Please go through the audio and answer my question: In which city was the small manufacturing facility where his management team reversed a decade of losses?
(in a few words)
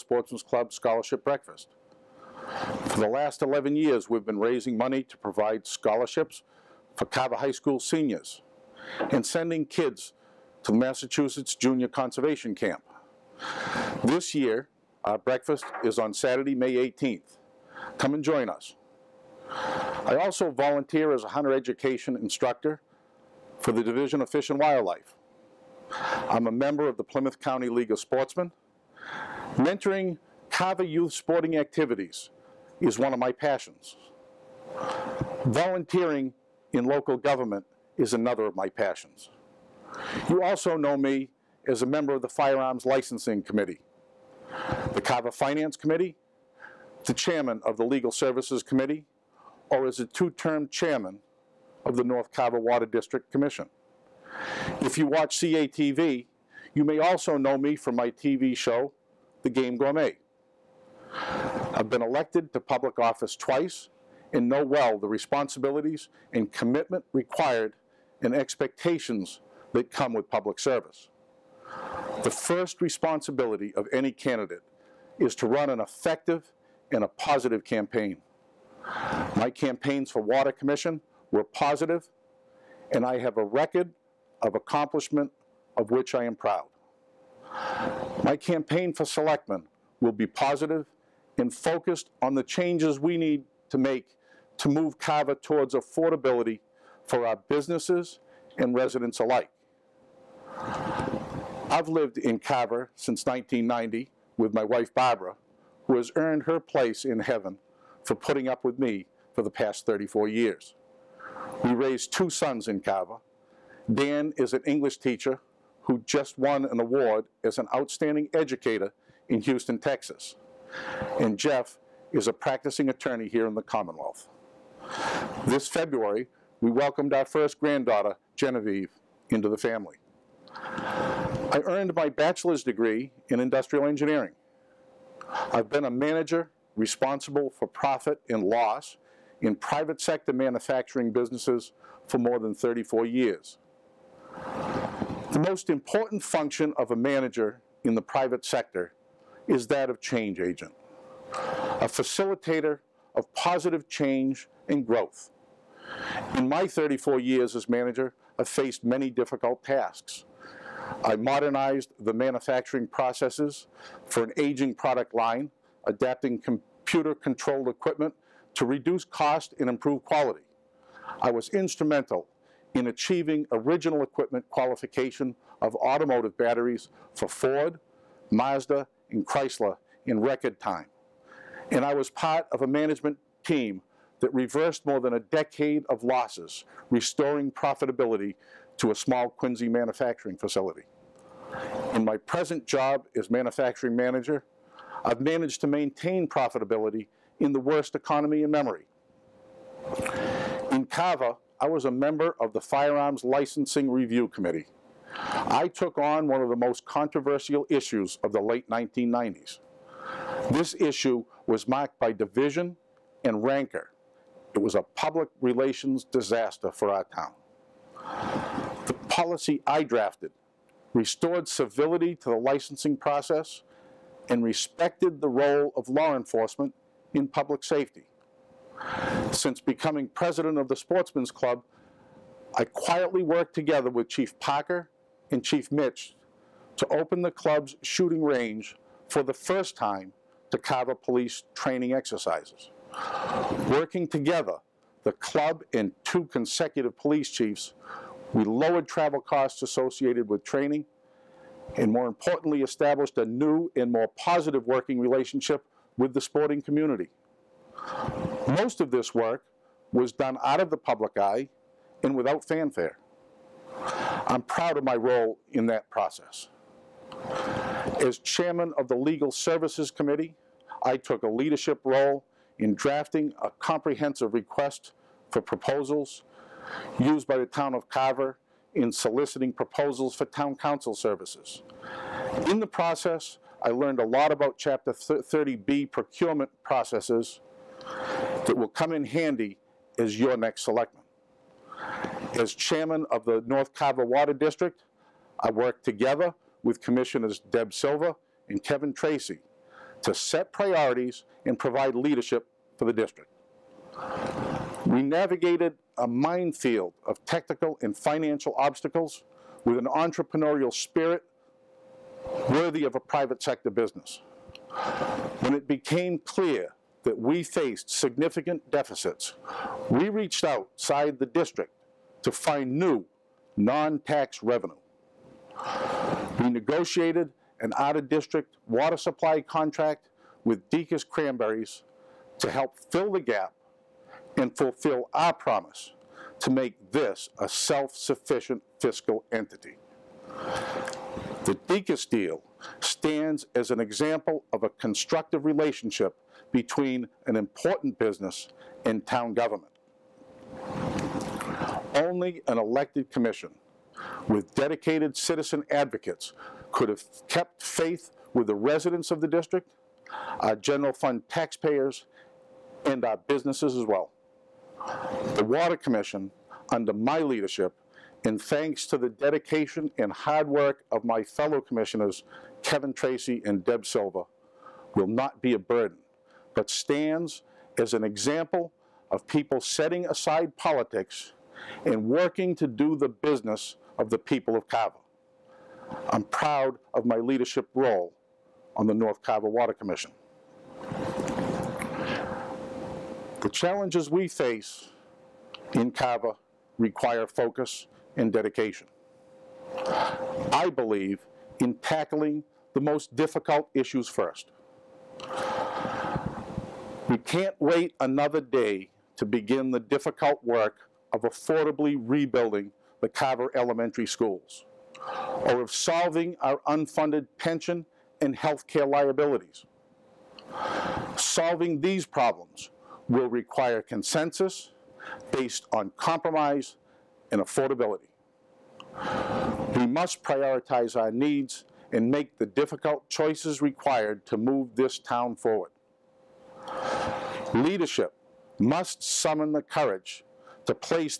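Quincy.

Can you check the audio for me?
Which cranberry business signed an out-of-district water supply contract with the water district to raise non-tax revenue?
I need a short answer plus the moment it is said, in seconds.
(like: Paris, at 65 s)
Deacon's Cranberries, at 330 s.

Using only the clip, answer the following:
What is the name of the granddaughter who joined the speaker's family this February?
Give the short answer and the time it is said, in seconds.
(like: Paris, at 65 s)
Genevieve, at 128 s.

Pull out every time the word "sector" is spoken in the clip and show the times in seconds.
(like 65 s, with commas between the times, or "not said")
140 s, 148 s, 313 s.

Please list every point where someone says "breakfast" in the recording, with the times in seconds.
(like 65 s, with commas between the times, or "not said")
1 s, 15 s.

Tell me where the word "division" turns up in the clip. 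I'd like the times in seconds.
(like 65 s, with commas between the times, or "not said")
23 s, 212 s.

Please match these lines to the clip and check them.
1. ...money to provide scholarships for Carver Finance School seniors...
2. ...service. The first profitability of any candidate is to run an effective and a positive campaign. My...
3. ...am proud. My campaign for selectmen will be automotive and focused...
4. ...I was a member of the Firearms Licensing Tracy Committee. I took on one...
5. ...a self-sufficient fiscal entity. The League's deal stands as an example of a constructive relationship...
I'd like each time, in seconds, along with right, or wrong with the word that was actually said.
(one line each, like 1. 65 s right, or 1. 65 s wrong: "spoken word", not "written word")
1. 4 s wrong: "High", not "Finance"
2. 70 s wrong: "responsibility", not "profitability"
3. 86 s wrong: "positive", not "automotive"
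4. 201 s wrong: "Review", not "Tracy"
5. 337 s wrong: "Deacon", not "League".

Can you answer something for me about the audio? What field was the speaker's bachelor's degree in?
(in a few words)
Industrial engineering.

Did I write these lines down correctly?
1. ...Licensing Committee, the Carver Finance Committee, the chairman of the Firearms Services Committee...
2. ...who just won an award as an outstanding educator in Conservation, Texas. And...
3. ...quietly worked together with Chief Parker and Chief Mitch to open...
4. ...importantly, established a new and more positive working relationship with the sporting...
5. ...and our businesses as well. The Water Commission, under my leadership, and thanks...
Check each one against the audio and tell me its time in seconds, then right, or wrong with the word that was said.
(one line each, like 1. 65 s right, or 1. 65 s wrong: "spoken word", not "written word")
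1. 42 s wrong: "Legal", not "Firearms"
2. 115 s wrong: "Houston", not "Conservation"
3. 232 s right
4. 252 s right
5. 362 s right.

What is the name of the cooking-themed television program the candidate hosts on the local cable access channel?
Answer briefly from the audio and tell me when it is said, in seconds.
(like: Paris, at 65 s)
The Game Gourmet, at 59 s.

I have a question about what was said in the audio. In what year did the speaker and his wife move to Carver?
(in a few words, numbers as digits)
1990.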